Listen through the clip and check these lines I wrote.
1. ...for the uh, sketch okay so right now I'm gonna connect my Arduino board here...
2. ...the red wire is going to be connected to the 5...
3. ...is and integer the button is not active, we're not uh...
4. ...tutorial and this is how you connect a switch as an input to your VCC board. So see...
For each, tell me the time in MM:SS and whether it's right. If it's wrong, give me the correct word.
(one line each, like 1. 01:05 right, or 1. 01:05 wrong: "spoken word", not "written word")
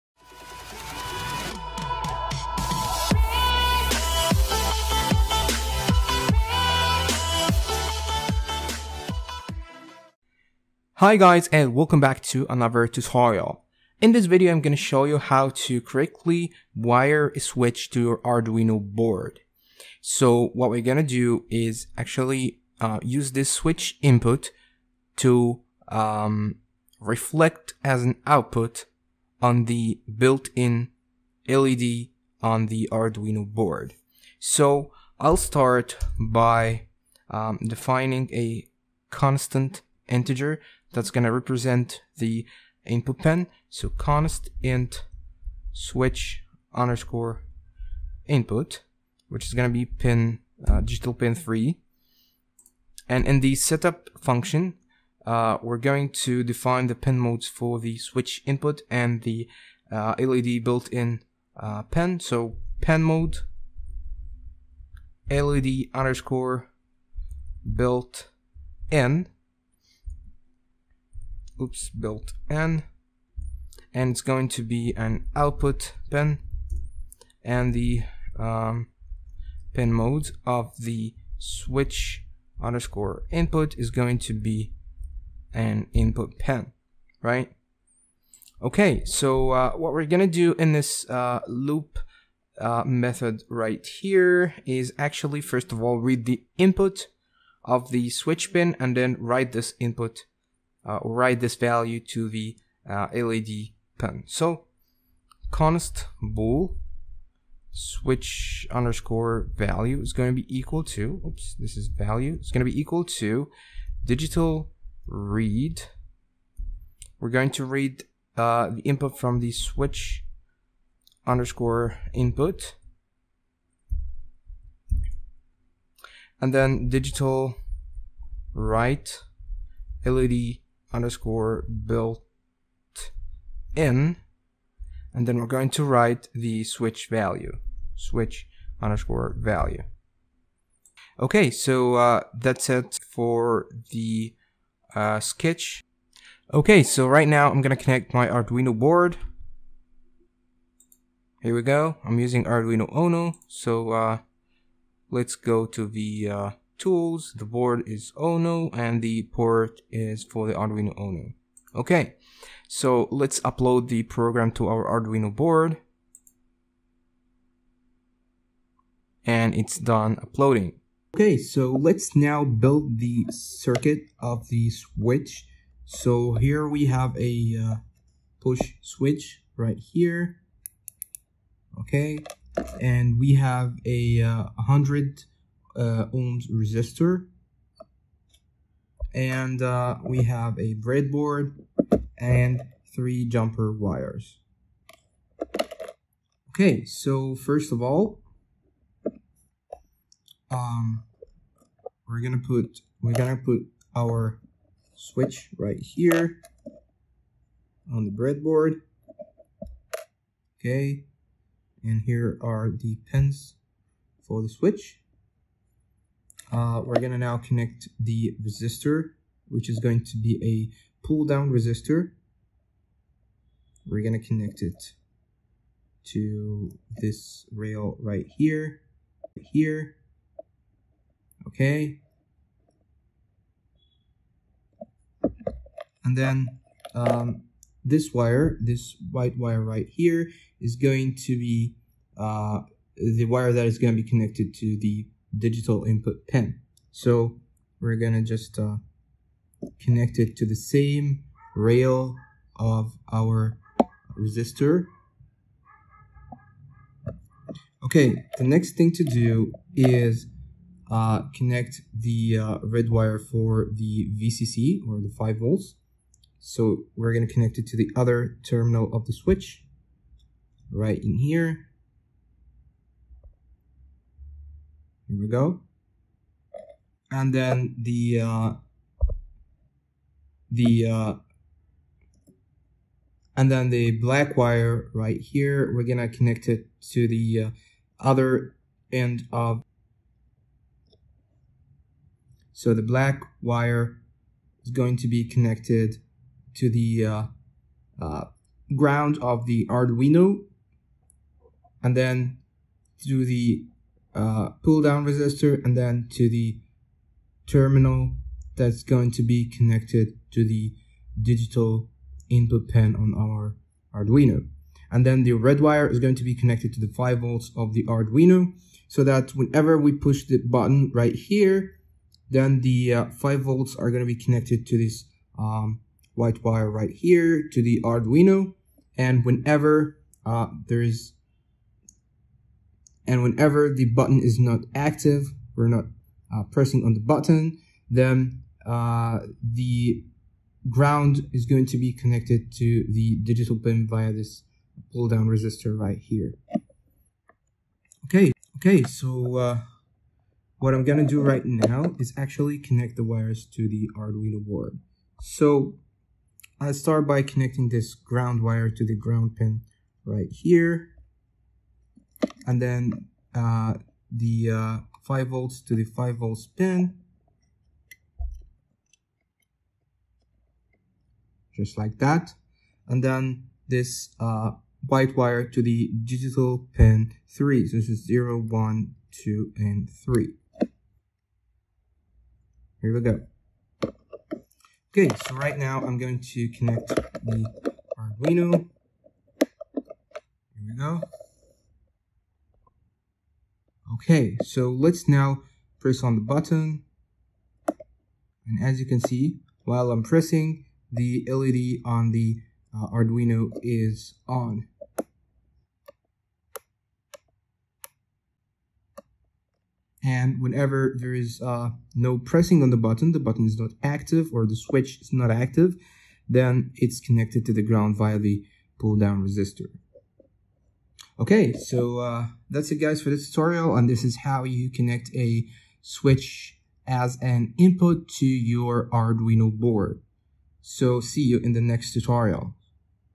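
1. 02:23 right
2. 05:15 right
3. 05:30 wrong: "whenever", not "integer"
4. 07:03 wrong: "Arduino", not "VCC".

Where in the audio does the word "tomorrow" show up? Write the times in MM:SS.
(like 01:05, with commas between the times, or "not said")
not said.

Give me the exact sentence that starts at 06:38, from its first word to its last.
And as you can see, while I'm pressing, the LED on the uh, Arduino is on.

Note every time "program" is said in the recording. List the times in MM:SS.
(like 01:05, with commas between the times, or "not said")
02:44.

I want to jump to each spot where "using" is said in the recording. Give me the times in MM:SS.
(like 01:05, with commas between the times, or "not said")
02:32.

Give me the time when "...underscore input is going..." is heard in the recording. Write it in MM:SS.
01:22.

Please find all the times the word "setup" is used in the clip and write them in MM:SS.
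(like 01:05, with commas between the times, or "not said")
00:53.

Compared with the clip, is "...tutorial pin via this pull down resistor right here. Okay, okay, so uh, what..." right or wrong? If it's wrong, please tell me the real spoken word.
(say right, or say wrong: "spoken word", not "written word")
wrong: "digital", not "tutorial".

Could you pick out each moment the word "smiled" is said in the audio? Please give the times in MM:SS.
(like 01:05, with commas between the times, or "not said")
not said.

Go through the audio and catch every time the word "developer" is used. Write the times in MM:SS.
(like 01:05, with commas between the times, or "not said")
not said.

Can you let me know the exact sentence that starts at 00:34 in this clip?
So I'll start by um, defining a constant integer that's going to represent the input pin.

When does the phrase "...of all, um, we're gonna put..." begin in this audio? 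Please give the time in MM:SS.
03:17.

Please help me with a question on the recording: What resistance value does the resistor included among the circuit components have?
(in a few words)
100 ohms.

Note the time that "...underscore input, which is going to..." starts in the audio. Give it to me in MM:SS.
00:46.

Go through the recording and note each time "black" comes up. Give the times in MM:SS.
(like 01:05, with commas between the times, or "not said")
04:43, 04:52.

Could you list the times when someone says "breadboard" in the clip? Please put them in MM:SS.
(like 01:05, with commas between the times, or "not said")
03:10, 03:28.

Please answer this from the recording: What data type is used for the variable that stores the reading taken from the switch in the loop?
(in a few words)
bool.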